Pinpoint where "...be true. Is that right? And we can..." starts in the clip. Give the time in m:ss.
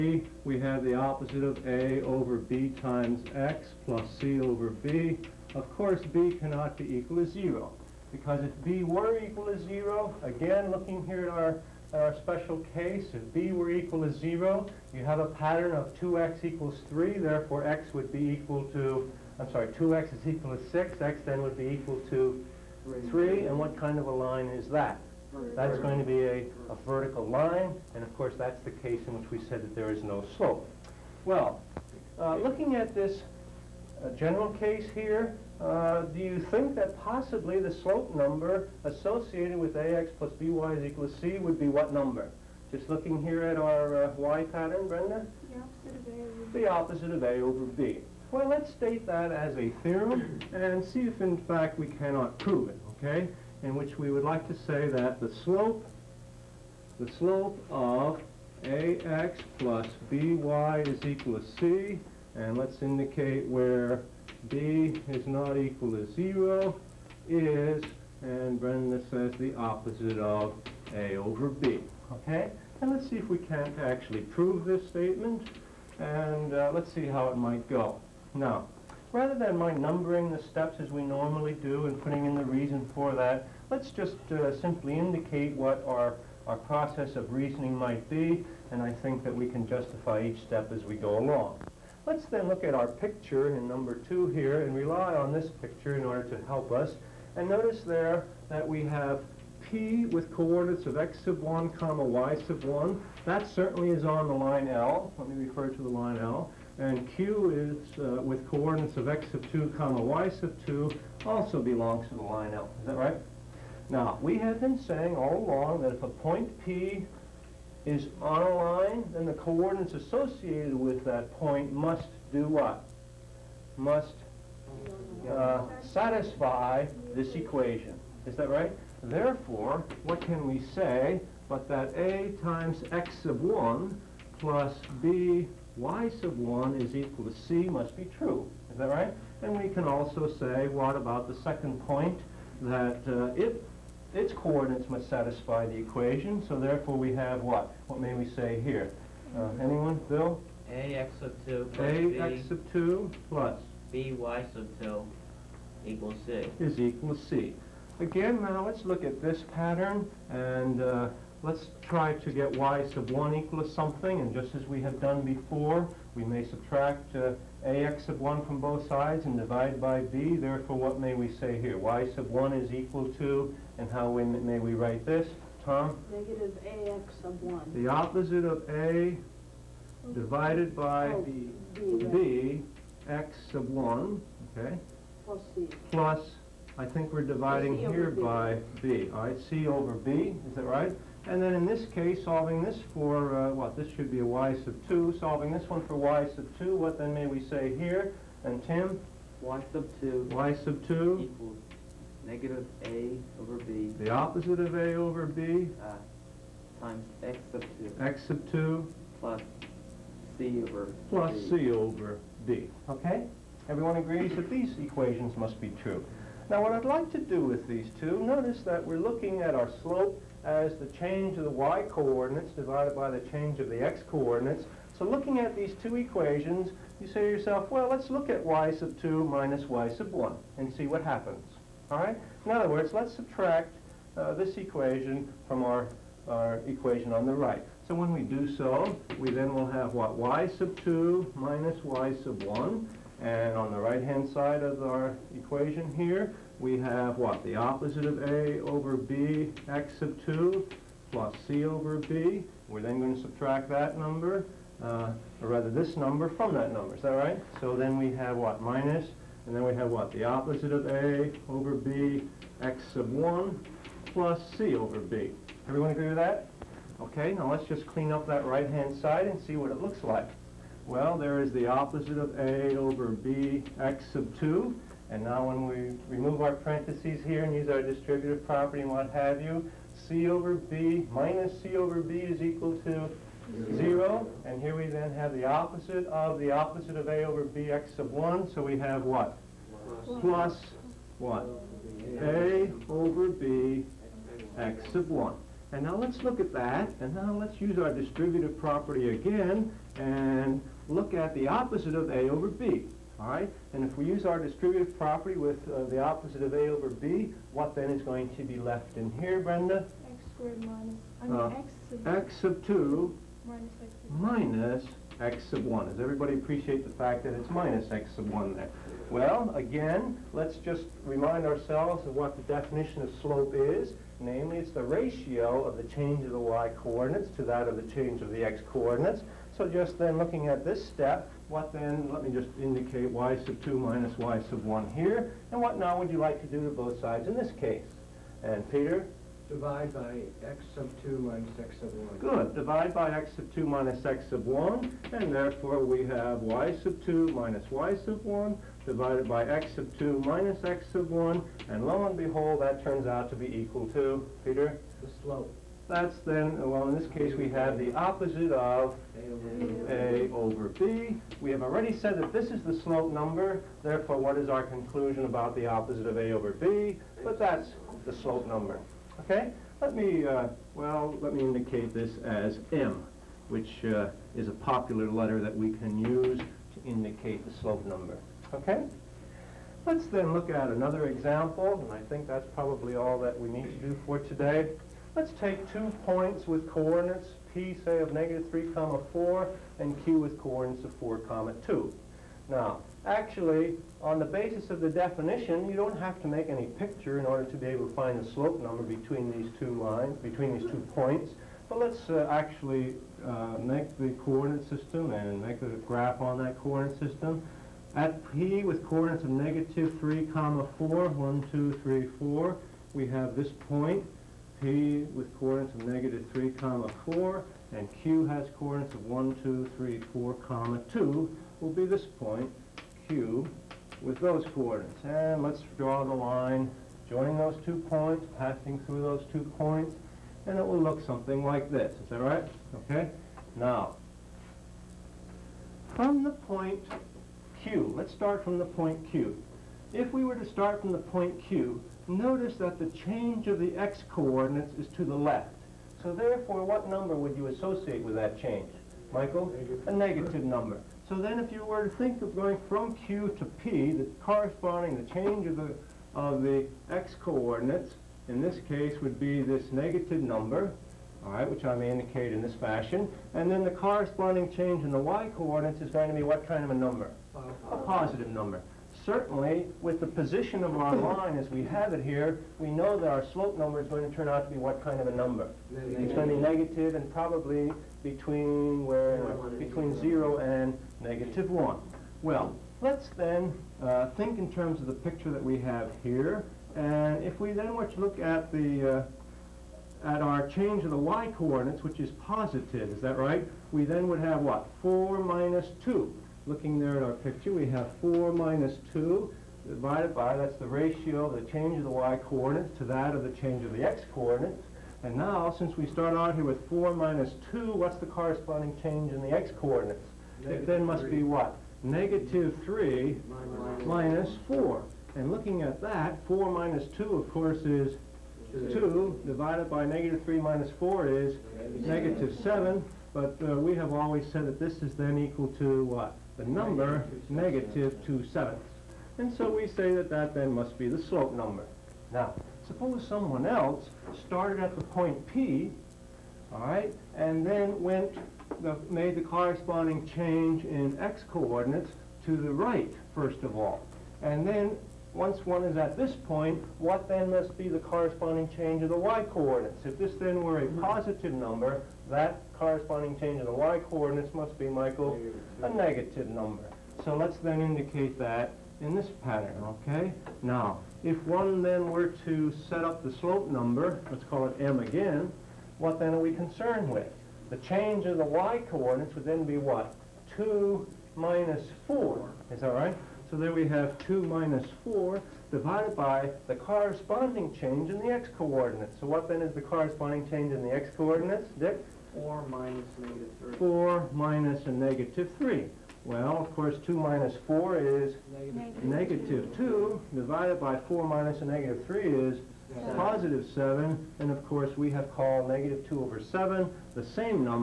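2:17.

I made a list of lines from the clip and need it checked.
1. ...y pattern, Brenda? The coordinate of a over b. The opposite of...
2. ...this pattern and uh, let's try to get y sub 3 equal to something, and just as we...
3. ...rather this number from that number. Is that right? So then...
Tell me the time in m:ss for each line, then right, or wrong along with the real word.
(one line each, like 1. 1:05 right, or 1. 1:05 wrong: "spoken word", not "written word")
1. 0:44 wrong: "opposite", not "coordinate"
2. 2:39 wrong: "1", not "3"
3. 4:15 right.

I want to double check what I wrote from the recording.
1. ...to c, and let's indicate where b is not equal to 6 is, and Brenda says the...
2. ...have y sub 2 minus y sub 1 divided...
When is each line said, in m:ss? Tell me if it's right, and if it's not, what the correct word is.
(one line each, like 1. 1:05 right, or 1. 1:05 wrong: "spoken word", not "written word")
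1. 1:01 wrong: "0", not "6"
2. 5:46 right.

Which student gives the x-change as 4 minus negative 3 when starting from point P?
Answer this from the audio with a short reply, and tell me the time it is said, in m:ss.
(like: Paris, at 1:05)
Dick, at 9:41.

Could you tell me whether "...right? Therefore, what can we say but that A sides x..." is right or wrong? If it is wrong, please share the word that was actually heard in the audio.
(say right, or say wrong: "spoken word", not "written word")
wrong: "times", not "sides".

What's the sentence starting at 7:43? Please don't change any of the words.
And then the corresponding change in the y-coordinates is going to be what kind of a number?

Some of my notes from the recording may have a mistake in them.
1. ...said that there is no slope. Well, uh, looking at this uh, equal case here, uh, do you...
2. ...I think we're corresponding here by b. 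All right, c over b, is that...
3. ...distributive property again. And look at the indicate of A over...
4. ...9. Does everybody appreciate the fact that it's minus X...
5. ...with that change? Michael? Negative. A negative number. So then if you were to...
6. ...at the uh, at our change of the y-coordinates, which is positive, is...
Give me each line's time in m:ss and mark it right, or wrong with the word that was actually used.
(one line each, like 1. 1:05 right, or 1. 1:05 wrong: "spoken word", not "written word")
1. 0:29 wrong: "general", not "equal"
2. 3:06 wrong: "dividing", not "corresponding"
3. 4:57 wrong: "opposite", not "indicate"
4. 5:15 wrong: "1", not "9"
5. 7:28 right
6. 8:08 right.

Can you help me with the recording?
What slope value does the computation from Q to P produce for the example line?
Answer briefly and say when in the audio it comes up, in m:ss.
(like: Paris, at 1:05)
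-2/7, at 8:47.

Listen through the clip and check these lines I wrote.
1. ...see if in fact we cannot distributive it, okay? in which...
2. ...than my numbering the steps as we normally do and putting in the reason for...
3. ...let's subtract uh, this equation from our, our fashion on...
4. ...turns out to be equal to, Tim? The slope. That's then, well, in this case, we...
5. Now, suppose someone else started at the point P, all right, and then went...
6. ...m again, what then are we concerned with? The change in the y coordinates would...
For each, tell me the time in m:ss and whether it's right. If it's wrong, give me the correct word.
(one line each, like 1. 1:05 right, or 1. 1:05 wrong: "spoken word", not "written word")
1. 0:50 wrong: "prove", not "distributive"
2. 1:19 right
3. 3:52 wrong: "equation", not "fashion"
4. 5:52 wrong: "Peter", not "Tim"
5. 8:52 right
6. 9:24 right.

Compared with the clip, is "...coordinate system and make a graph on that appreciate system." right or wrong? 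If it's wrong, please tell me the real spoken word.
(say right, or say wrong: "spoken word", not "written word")
wrong: "coordinate", not "appreciate".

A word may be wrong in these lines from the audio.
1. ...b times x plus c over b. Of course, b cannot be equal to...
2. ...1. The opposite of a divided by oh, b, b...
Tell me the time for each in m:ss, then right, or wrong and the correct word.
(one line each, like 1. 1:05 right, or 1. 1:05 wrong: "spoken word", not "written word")
1. 0:02 right
2. 2:57 right.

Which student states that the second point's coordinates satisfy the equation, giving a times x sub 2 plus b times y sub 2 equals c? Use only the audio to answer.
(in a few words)
Bill.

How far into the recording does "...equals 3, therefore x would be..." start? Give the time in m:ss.
0:16.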